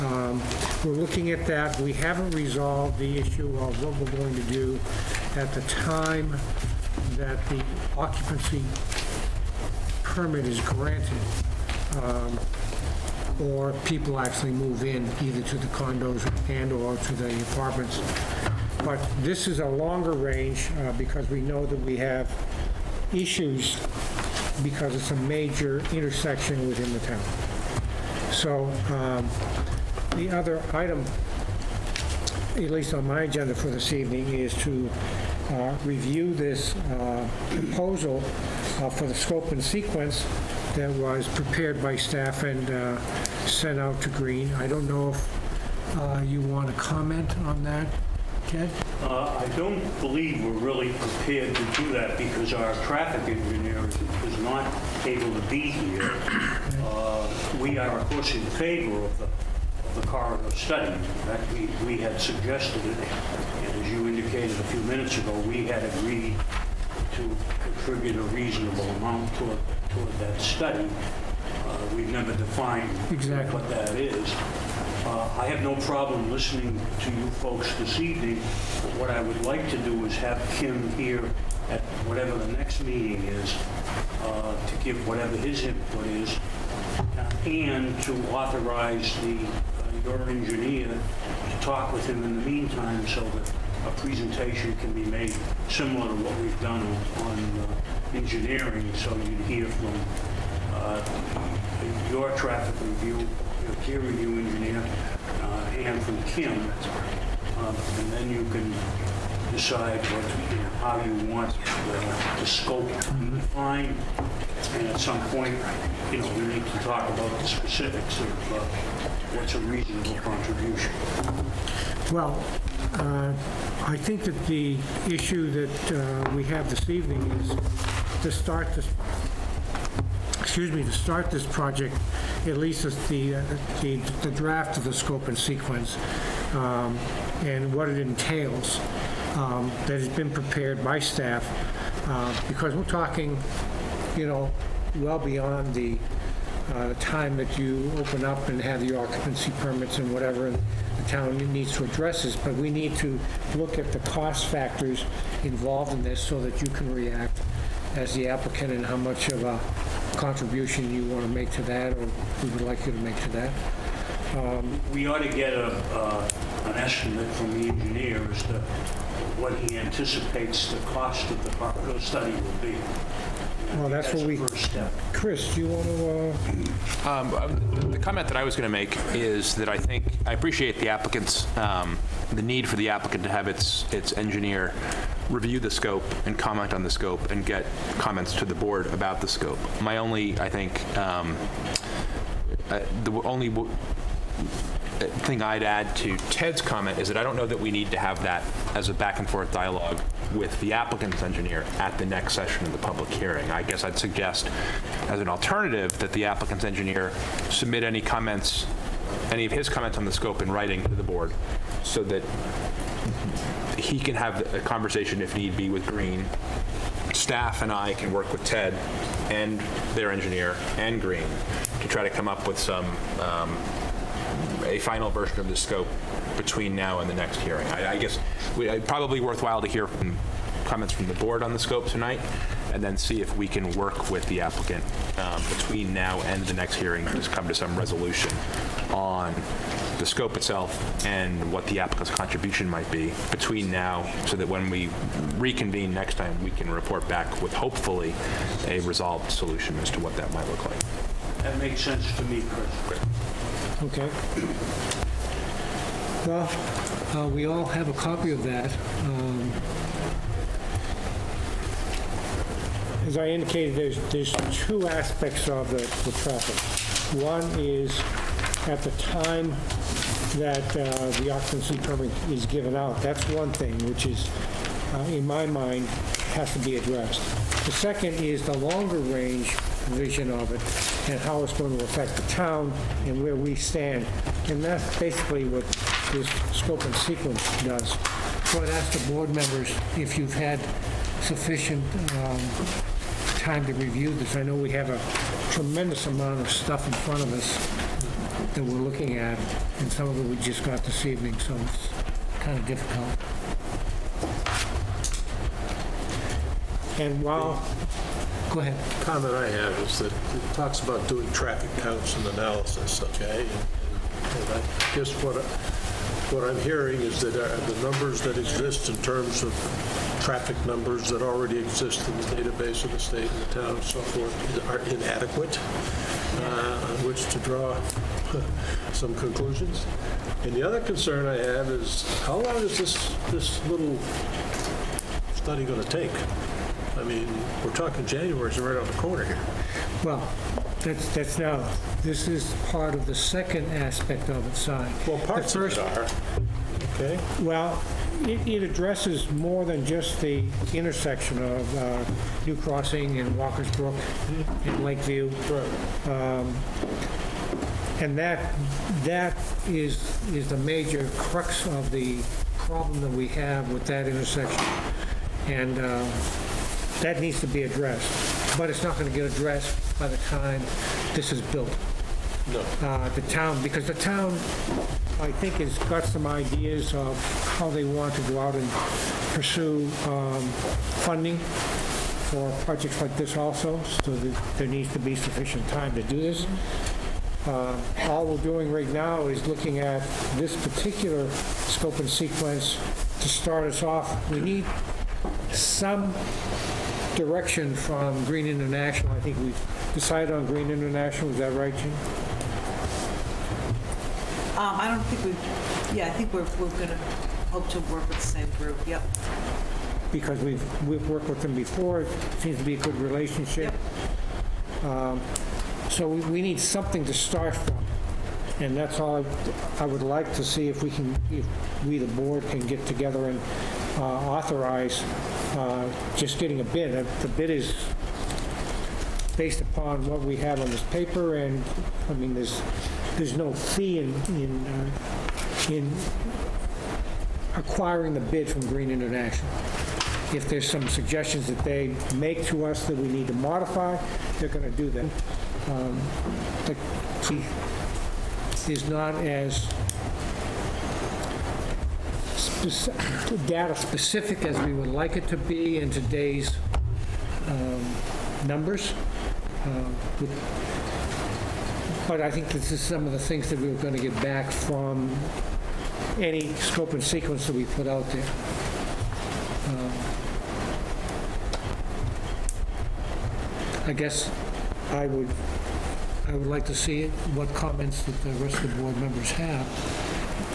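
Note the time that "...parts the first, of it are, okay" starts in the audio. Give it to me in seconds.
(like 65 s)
345 s.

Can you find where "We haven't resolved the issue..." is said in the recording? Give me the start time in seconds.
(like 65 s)
1 s.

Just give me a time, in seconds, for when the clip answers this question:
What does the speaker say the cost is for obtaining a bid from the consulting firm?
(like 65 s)
433 s.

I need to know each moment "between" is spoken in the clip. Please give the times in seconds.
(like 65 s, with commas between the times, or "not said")
226 s, 235 s, 243 s.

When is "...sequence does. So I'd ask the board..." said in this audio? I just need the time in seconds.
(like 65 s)
286 s.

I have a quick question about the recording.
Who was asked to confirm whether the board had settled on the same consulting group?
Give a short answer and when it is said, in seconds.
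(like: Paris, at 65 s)
Jim, at 401 s.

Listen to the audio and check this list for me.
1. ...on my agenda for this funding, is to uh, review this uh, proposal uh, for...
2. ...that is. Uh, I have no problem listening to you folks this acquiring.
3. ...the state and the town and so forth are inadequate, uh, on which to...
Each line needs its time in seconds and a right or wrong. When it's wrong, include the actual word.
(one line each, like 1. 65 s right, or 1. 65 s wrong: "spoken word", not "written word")
1. 32 s wrong: "evening", not "funding"
2. 73 s wrong: "evening", not "acquiring"
3. 322 s right.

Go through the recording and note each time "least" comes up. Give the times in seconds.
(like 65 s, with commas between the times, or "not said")
32 s, 132 s.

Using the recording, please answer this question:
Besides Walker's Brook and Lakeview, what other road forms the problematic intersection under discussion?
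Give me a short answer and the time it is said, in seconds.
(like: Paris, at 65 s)
New Crossing, at 352 s.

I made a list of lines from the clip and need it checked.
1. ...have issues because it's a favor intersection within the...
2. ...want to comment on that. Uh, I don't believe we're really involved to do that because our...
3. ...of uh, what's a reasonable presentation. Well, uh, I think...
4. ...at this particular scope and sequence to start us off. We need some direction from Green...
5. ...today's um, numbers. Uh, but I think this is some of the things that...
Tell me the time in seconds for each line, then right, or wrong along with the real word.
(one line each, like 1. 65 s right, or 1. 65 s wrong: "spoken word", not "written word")
1. 21 s wrong: "major", not "favor"
2. 46 s wrong: "prepared", not "involved"
3. 118 s wrong: "contribution", not "presentation"
4. 389 s right
5. 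455 s right.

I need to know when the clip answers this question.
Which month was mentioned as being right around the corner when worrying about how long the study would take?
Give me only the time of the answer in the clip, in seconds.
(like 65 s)
338 s.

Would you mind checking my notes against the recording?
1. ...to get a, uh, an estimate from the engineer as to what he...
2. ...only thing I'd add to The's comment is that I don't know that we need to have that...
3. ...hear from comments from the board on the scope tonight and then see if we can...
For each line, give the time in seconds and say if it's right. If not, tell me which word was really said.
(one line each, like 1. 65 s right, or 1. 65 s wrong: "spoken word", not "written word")
1. 165 s right
2. 193 s wrong: "Ted", not "The"
3. 229 s right.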